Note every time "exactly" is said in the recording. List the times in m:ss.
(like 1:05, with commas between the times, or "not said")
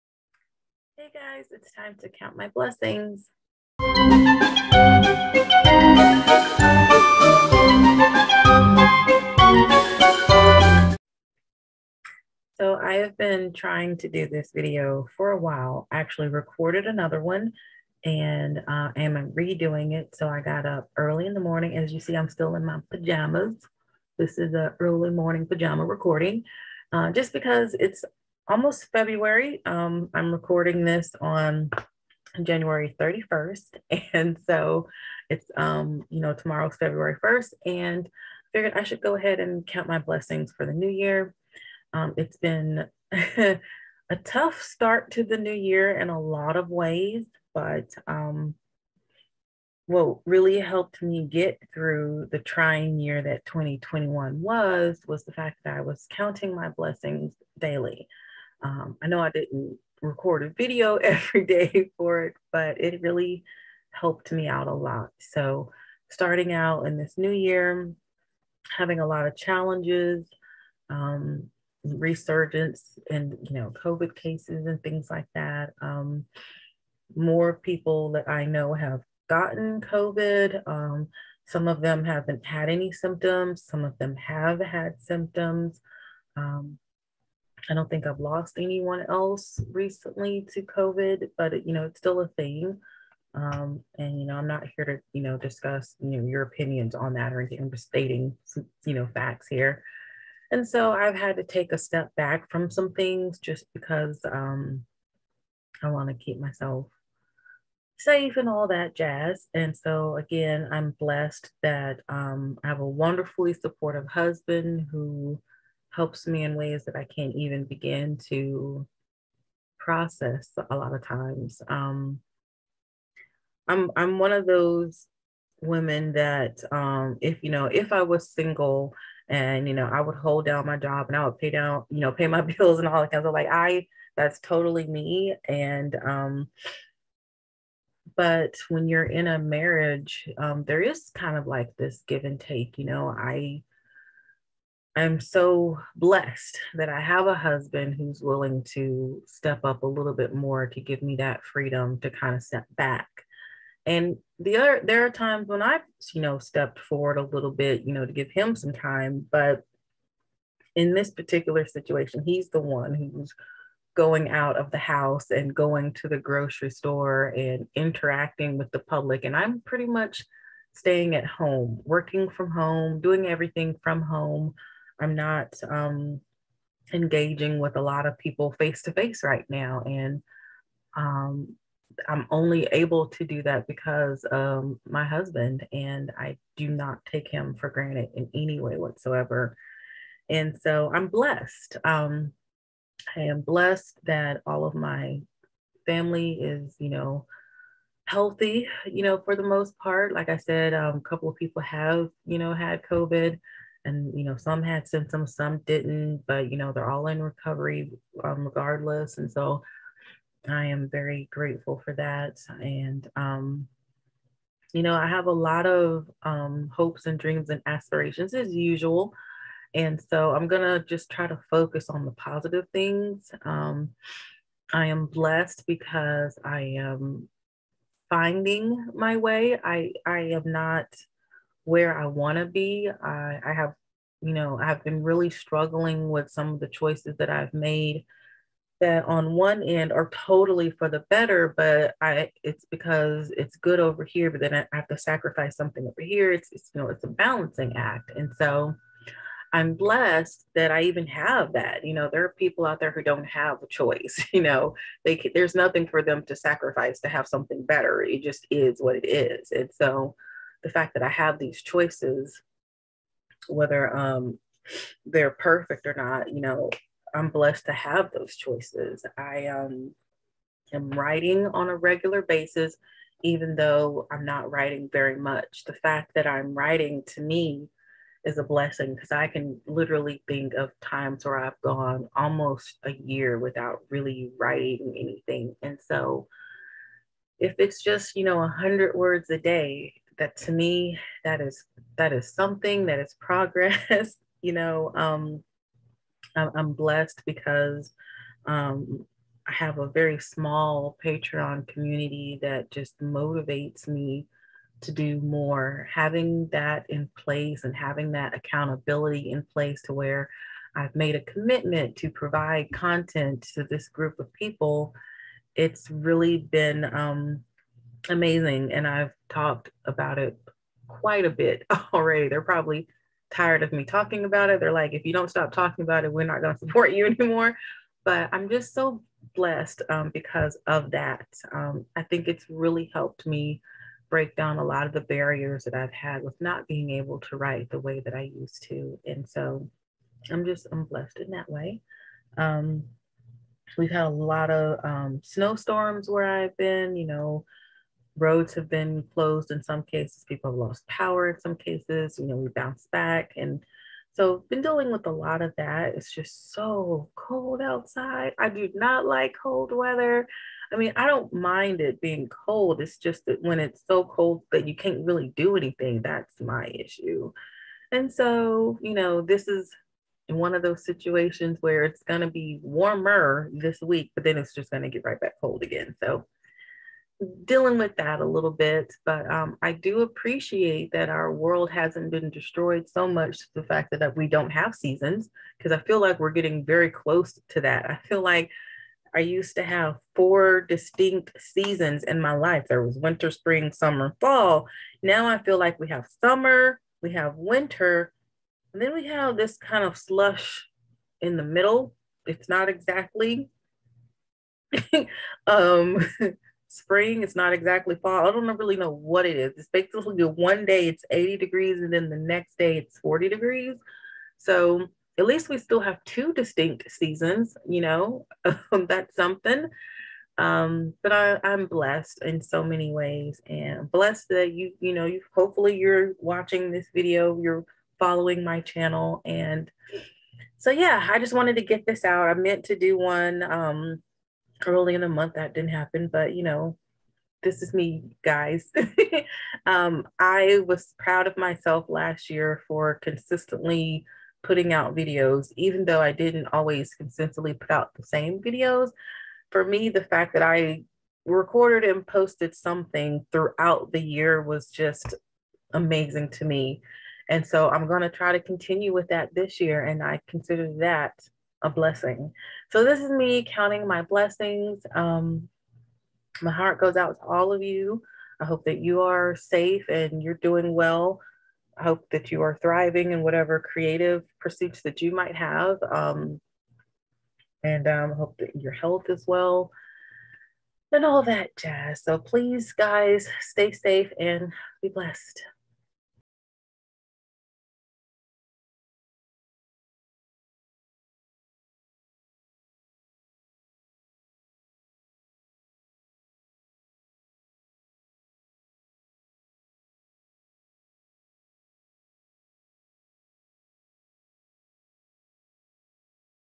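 6:42, 6:47.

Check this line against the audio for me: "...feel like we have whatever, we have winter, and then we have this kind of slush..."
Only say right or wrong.
wrong.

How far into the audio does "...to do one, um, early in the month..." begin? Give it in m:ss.
7:12.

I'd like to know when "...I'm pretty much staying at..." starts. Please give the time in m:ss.
2:49.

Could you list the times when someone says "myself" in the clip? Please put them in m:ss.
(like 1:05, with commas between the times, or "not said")
1:46, 7:21.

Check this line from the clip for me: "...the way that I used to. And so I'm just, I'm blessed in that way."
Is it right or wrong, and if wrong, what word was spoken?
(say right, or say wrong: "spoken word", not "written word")
right.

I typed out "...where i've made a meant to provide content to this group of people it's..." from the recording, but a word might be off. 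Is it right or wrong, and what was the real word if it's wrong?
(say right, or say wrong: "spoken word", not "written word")
wrong: "commitment", not "meant".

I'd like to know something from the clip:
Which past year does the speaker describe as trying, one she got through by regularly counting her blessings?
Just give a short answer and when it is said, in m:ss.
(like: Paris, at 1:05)
2021, at 0:53.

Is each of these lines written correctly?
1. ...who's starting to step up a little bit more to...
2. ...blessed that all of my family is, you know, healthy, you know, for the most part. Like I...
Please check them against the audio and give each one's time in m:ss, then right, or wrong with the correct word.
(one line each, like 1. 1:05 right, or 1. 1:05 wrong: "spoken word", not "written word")
1. 2:27 wrong: "willing", not "starting"
2. 3:13 right.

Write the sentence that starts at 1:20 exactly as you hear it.
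Um, some of them haven't had any symptoms.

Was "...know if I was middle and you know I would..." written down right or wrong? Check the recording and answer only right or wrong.
wrong.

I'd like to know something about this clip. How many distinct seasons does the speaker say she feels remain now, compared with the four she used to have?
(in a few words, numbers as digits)
2.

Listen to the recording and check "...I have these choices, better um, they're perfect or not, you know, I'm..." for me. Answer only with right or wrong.
wrong.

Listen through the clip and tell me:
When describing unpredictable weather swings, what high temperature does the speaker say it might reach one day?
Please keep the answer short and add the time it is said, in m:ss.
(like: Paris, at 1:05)
80 degrees, at 6:51.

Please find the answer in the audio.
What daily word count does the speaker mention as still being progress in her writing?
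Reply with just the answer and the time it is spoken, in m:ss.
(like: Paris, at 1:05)
100, at 4:48.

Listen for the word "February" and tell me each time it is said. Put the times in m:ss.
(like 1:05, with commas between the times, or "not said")
0:28, 0:36.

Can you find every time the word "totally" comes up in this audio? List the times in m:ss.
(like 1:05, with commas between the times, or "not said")
2:14, 4:00.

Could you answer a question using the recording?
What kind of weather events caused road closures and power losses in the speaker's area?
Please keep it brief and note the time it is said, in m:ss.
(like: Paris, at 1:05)
snowstorms, at 5:45.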